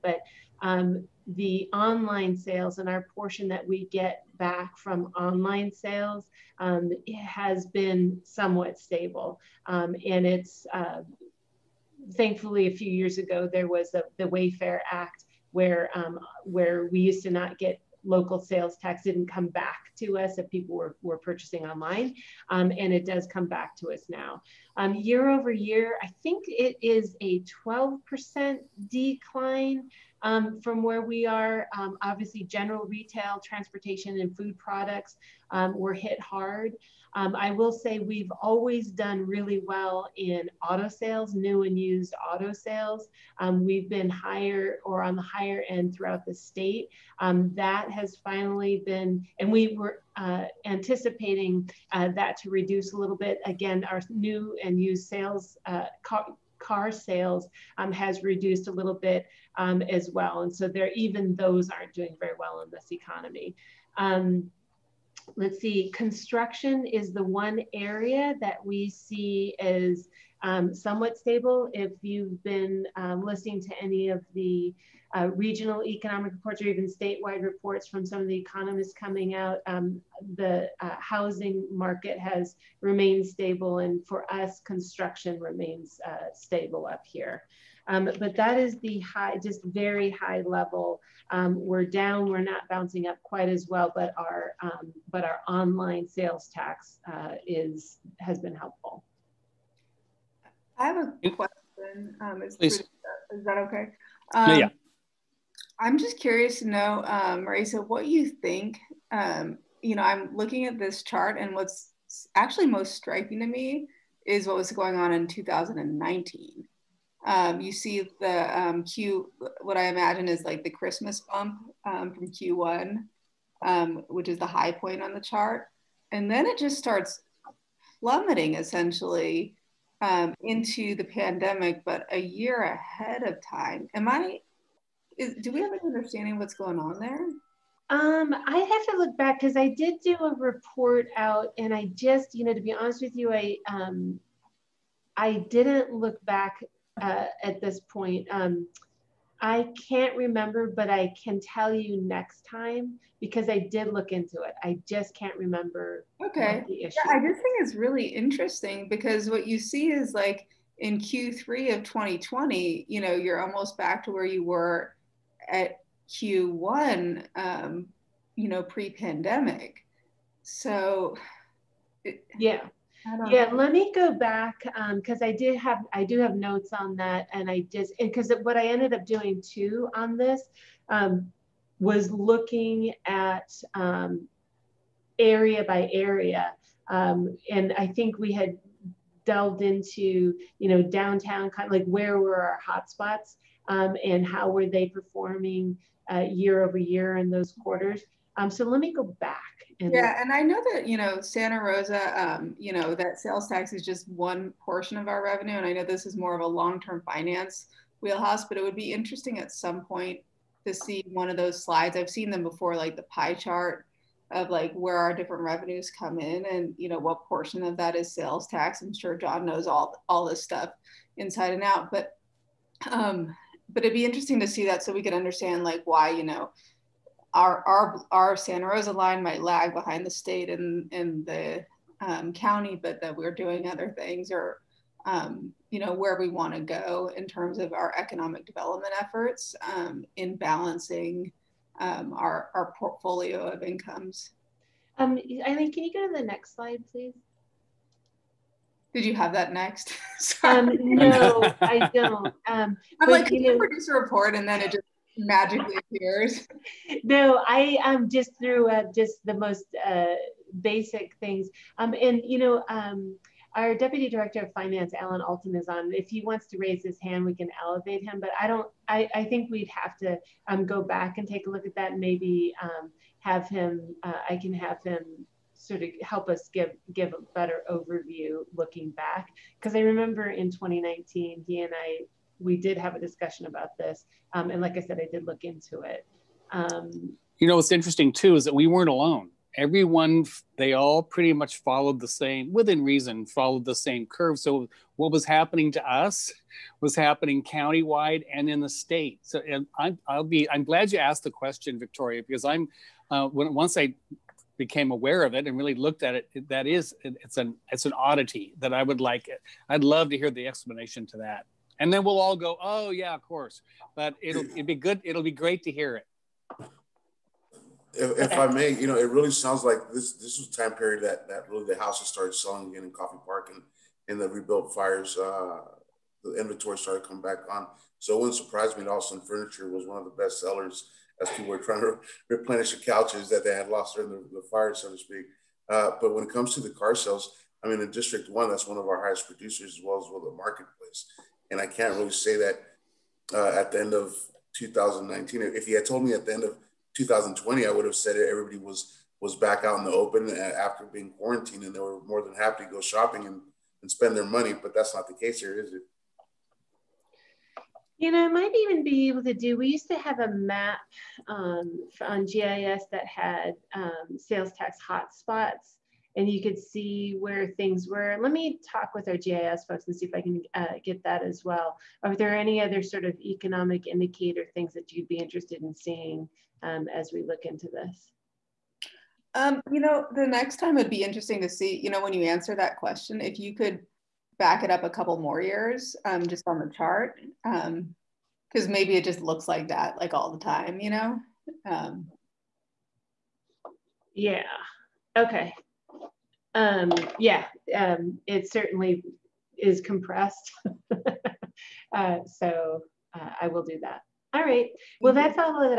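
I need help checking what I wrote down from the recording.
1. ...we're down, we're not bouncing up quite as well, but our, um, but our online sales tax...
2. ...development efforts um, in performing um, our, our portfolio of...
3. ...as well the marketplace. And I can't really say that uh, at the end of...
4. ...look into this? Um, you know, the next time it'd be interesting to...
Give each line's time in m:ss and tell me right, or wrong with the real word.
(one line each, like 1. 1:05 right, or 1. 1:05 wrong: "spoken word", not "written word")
1. 1:31 right
2. 3:58 wrong: "balancing", not "performing"
3. 5:39 right
4. 6:17 right.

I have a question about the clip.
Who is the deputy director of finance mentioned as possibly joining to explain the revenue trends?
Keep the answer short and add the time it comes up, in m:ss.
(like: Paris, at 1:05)
Alan Alton, at 4:24.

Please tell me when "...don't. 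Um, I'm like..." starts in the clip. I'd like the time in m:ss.
4:11.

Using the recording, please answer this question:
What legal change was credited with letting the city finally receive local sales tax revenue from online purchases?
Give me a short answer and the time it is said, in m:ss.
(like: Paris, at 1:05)
Wayfair Act, at 0:14.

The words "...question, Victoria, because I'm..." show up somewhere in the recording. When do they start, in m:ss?
5:01.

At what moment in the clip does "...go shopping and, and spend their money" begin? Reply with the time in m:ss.
5:52.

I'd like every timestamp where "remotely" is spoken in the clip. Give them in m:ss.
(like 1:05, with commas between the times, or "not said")
not said.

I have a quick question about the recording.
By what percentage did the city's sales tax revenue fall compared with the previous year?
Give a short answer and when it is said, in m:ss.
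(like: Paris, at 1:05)
12%, at 0:27.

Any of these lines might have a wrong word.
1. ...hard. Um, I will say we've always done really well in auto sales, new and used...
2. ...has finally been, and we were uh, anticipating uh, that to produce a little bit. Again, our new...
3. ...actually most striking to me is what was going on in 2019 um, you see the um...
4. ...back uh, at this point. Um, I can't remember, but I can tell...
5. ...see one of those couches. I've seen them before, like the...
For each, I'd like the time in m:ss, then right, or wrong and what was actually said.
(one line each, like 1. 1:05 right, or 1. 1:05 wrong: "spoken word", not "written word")
1. 0:36 right
2. 0:47 wrong: "reduce", not "produce"
3. 1:52 right
4. 2:26 right
5. 3:30 wrong: "slides", not "couches".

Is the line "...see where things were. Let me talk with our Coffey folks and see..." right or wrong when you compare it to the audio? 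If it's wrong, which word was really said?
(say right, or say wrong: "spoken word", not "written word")
wrong: "GIS", not "Coffey".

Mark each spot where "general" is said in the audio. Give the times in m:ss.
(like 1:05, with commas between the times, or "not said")
0:32.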